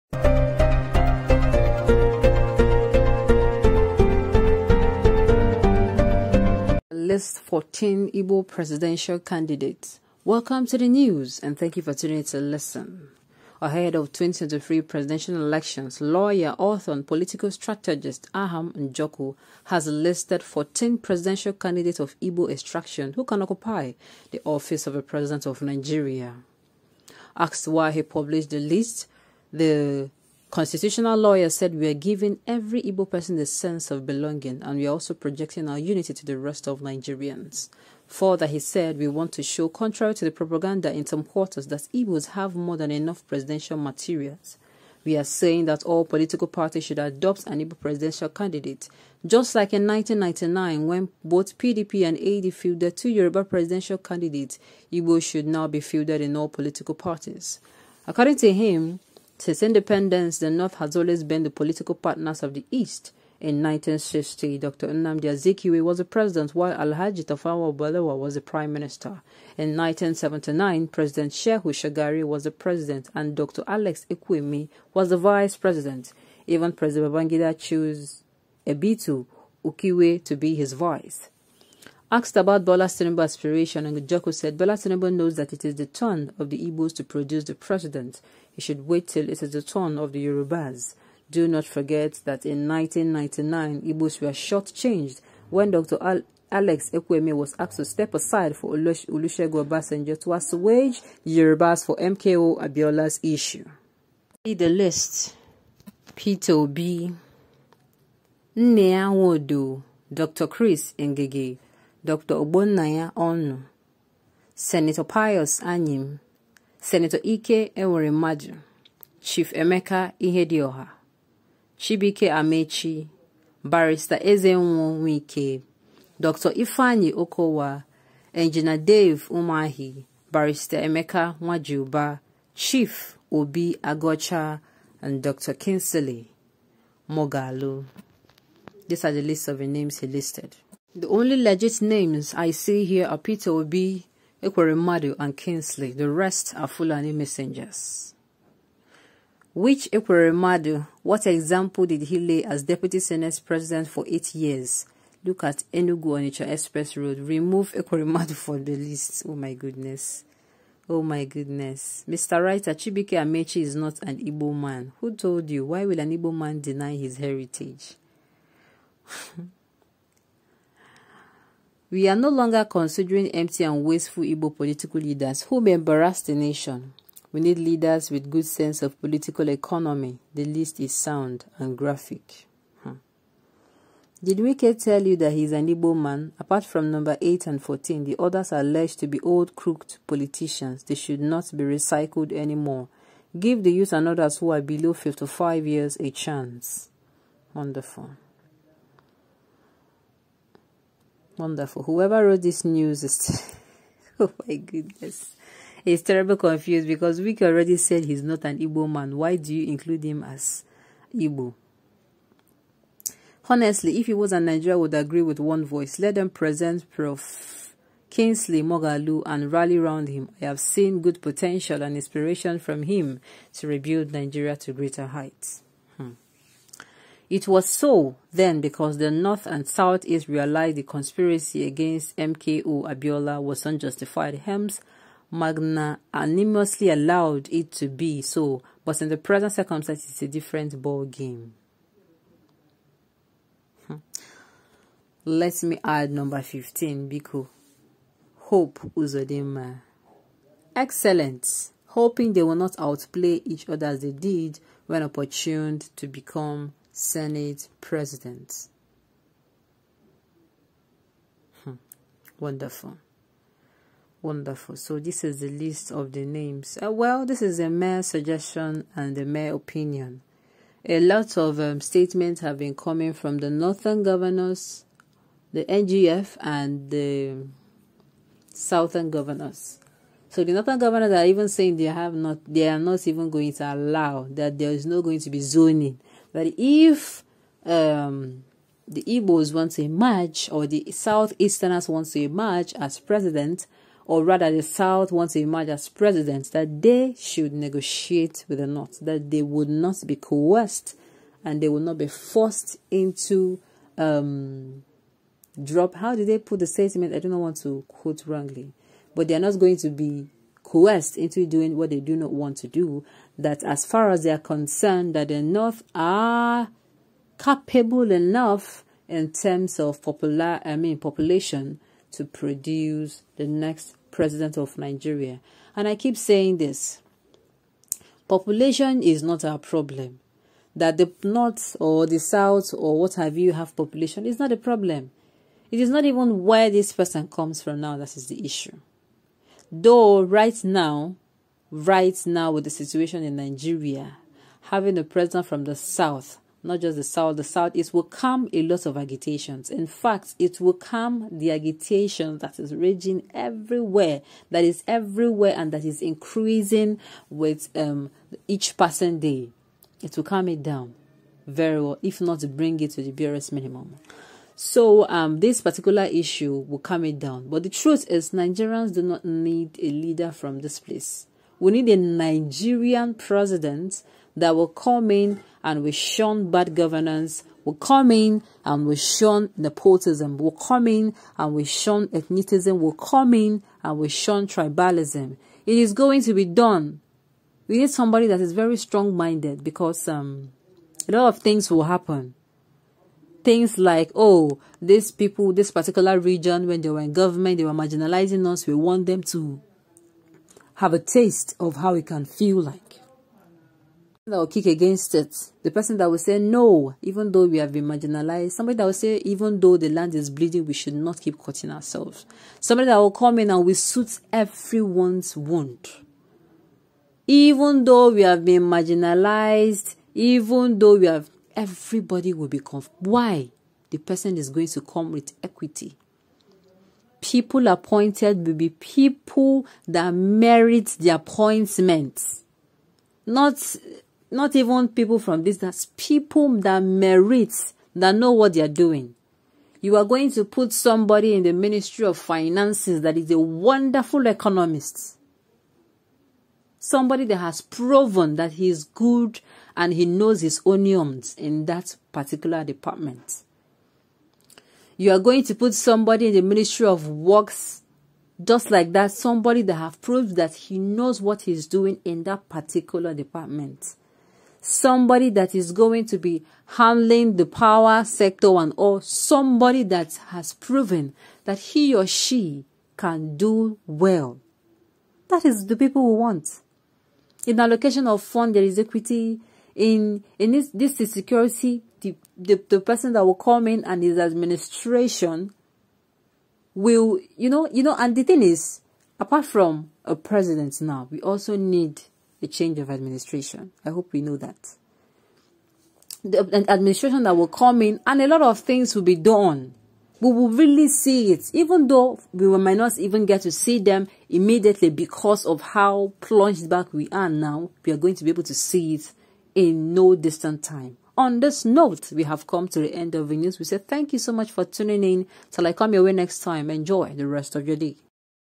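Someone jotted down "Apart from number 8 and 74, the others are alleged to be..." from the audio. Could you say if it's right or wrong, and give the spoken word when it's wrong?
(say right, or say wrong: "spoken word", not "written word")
wrong: "14", not "74".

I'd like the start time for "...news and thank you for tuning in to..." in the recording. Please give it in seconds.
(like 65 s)
10 s.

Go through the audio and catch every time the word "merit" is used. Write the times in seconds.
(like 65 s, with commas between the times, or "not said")
430 s, 436 s.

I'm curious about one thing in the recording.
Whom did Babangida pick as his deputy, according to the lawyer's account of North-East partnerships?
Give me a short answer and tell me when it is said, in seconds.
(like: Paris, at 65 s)
Ebitu Ukiwe, at 78 s.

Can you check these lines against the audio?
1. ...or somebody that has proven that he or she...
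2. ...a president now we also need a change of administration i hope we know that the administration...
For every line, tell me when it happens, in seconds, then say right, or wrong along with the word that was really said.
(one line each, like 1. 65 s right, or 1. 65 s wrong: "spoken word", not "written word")
1. 468 s right
2. 490 s right.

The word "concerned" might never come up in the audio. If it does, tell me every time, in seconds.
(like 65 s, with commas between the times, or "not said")
314 s.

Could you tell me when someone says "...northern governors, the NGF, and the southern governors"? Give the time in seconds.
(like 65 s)
273 s.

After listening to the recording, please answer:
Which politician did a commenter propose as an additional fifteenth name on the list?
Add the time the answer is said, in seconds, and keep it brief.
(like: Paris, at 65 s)
Hope Uzodimma, at 248 s.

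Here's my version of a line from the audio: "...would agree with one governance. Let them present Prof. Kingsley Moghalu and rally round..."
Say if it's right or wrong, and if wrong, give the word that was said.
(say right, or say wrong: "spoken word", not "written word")
wrong: "voice", not "governance".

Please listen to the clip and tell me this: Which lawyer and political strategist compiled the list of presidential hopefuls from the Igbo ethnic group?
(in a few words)
Aham Njoku.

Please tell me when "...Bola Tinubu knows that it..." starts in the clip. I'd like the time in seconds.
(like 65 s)
84 s.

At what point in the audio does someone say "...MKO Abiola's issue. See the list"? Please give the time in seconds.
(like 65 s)
101 s.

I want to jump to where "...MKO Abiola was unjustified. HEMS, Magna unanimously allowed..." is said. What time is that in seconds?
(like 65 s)
232 s.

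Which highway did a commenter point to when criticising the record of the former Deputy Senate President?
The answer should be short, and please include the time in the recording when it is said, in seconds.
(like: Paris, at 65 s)
Enugu Onitsha Express Road, at 155 s.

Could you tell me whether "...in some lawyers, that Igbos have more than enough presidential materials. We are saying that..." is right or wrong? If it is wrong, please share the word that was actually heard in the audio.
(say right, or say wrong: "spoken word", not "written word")
wrong: "quarters", not "lawyers".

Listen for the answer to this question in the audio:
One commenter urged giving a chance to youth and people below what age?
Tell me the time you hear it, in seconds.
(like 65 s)
194 s.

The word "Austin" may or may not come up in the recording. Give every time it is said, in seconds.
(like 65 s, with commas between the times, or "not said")
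not said.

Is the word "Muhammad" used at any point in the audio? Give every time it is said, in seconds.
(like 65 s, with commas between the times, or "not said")
not said.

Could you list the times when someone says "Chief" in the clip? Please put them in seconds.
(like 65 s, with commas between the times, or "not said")
119 s, 132 s.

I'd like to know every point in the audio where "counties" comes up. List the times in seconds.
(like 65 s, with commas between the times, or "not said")
not said.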